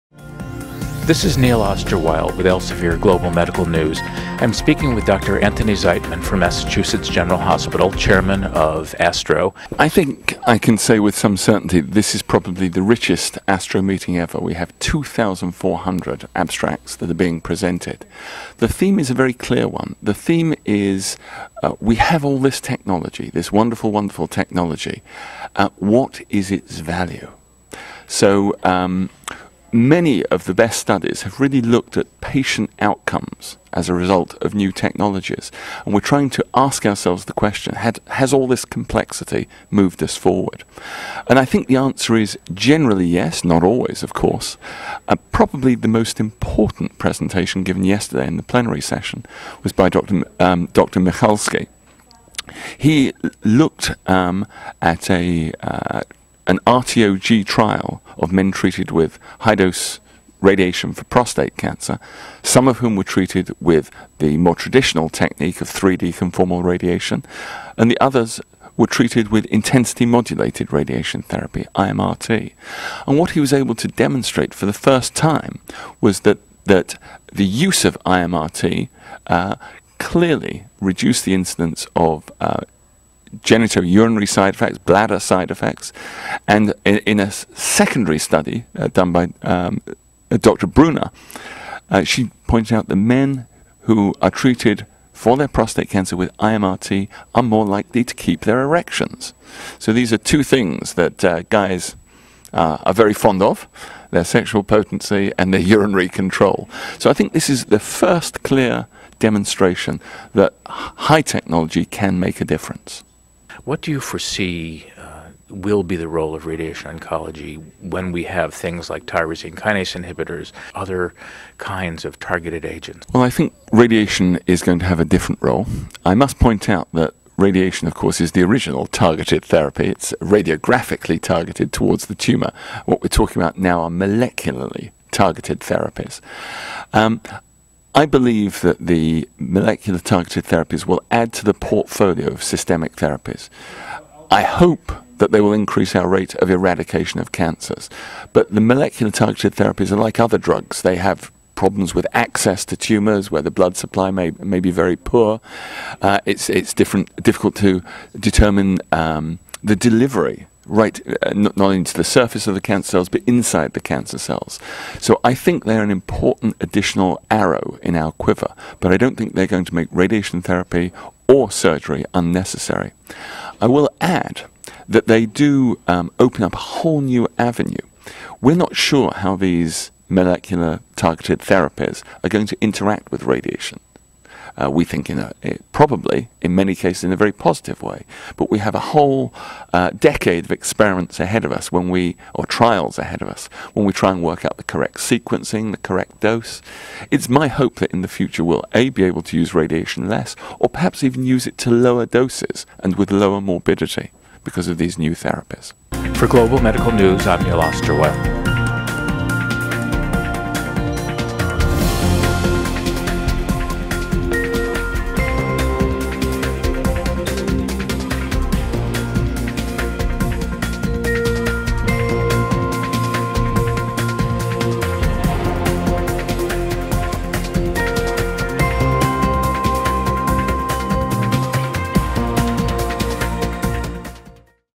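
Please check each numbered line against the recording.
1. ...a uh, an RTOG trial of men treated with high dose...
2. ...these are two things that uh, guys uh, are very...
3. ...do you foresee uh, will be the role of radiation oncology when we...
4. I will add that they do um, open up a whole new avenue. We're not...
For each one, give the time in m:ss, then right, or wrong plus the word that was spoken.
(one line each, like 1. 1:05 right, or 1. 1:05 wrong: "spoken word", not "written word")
1. 0:55 right
2. 1:39 right
3. 1:53 right
4. 2:53 right.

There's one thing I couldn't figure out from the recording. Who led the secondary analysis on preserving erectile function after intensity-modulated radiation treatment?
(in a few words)
Dr. Bruner.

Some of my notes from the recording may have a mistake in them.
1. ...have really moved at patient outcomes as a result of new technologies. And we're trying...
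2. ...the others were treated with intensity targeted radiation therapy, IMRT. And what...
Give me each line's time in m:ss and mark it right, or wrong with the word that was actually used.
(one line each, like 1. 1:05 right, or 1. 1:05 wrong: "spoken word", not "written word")
1. 0:31 wrong: "looked", not "moved"
2. 1:07 wrong: "modulated", not "targeted".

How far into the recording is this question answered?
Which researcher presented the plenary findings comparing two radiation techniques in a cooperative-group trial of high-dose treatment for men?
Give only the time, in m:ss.
0:50.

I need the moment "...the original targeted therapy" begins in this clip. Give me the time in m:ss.
2:08.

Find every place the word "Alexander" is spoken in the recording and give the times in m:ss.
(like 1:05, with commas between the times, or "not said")
not said.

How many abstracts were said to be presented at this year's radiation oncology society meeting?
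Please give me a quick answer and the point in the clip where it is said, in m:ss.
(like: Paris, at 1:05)
2,400, at 0:14.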